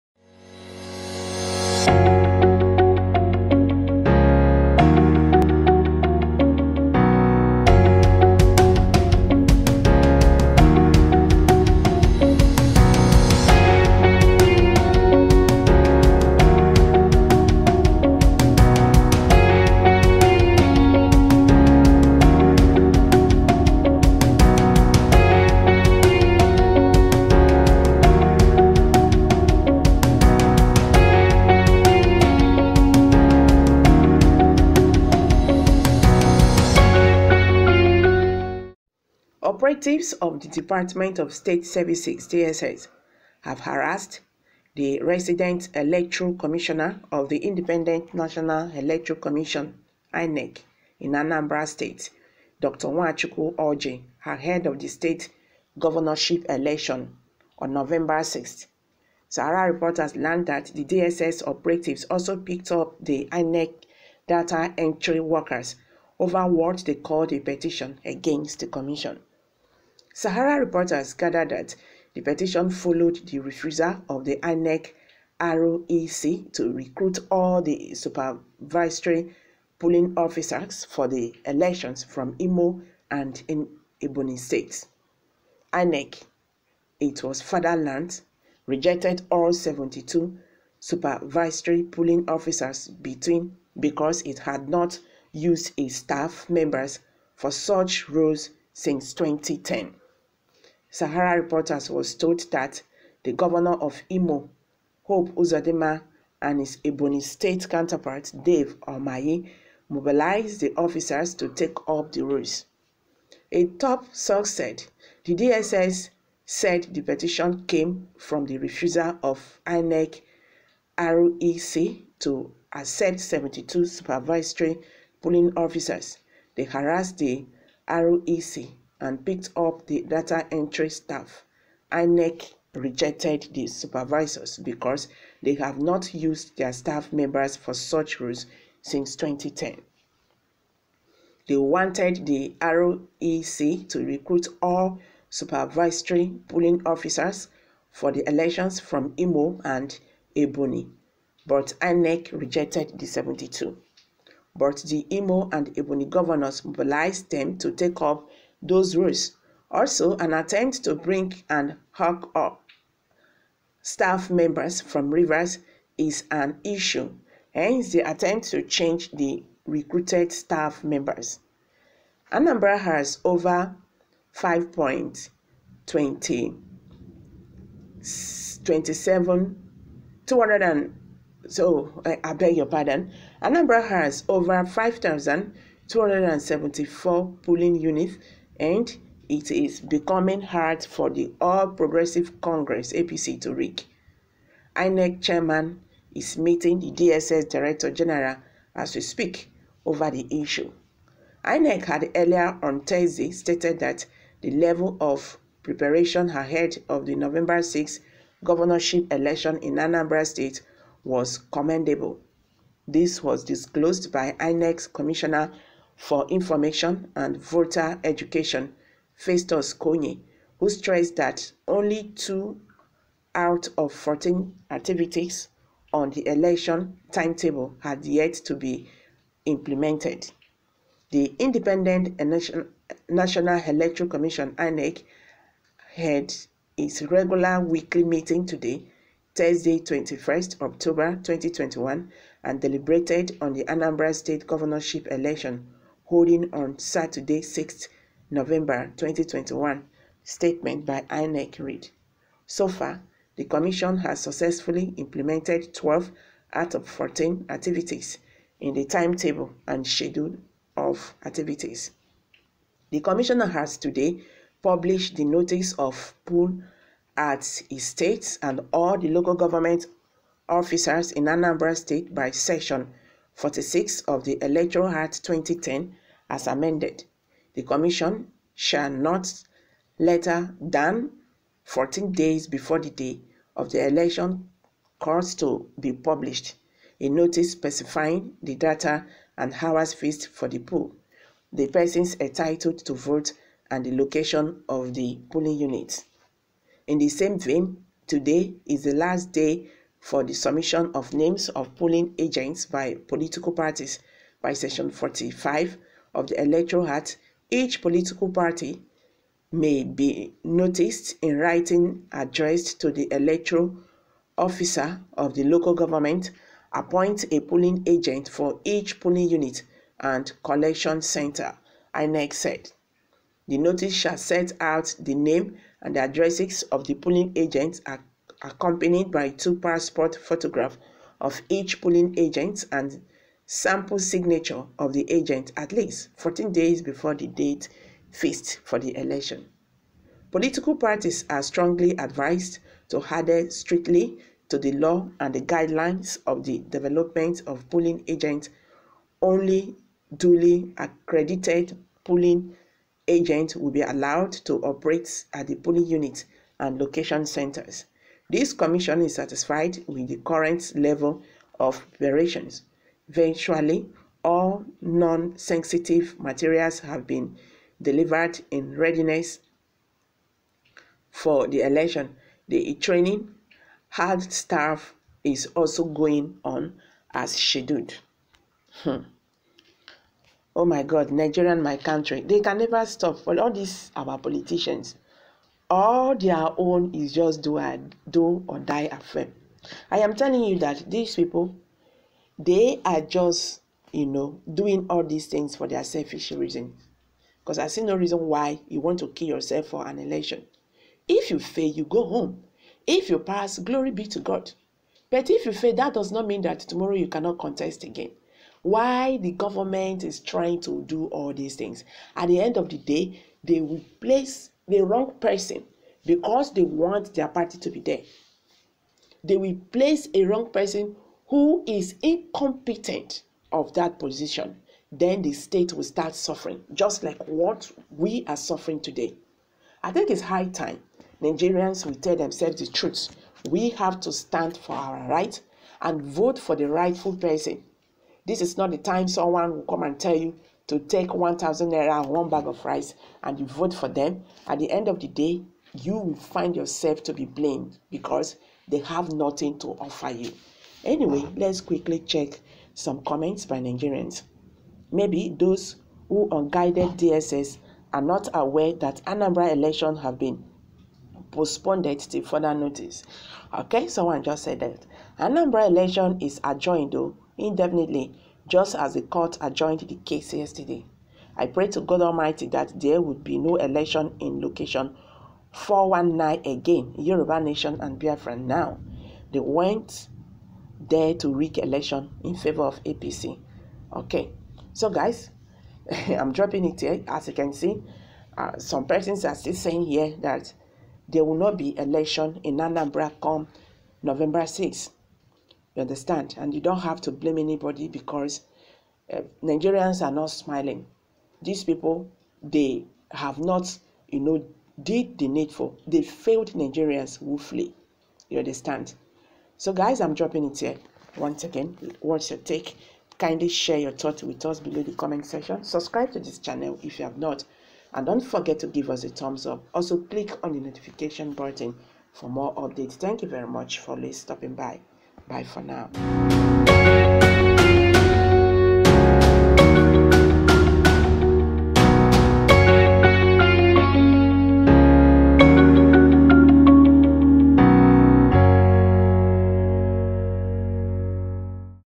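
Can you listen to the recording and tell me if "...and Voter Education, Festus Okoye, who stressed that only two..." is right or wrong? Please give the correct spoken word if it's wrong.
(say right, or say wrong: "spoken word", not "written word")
right.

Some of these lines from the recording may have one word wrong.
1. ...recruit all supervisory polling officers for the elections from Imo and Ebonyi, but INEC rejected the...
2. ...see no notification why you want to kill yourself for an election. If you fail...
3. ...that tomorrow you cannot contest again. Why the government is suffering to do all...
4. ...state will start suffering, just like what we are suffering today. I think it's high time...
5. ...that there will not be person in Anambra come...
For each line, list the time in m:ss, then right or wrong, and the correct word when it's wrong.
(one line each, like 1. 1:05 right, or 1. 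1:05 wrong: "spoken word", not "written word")
1. 2:24 right
2. 6:37 wrong: "reason", not "notification"
3. 6:46 wrong: "trying", not "suffering"
4. 7:05 right
5. 8:10 wrong: "election", not "person".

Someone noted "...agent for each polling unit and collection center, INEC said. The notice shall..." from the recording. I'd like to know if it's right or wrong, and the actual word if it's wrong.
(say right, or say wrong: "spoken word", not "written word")
right.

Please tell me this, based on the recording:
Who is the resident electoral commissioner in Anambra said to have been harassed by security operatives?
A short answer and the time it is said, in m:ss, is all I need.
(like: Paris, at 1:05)
Dr. Nwachukwu Orji, at 0:52.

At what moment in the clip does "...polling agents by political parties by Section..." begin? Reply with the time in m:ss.
5:01.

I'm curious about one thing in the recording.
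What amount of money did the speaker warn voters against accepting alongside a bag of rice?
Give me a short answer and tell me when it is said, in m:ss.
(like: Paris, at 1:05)
1,000 naira, at 7:21.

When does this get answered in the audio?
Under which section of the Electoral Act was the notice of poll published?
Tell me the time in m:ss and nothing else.
4:32.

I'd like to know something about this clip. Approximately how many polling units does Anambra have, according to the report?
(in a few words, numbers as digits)
5,274.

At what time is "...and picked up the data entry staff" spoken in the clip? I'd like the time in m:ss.
2:09.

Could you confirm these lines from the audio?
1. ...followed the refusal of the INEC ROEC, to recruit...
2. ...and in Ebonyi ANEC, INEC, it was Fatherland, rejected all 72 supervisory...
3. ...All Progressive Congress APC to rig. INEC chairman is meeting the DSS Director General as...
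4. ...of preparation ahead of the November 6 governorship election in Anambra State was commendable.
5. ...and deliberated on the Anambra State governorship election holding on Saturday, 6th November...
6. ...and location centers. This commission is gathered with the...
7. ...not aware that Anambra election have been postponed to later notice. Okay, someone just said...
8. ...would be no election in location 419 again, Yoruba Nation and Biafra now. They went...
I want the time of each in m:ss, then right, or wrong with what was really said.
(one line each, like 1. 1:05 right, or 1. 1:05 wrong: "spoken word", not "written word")
1. 1:12 right
2. 1:23 right
3. 3:11 right
4. 3:24 right
5. 4:02 right
6. 5:56 wrong: "satisfied", not "gathered"
7. 7:38 wrong: "further", not "later"
8. 7:53 right.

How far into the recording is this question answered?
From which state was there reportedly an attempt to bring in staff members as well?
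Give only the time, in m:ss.
2:45.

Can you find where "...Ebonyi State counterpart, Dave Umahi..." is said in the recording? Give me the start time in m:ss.
1:46.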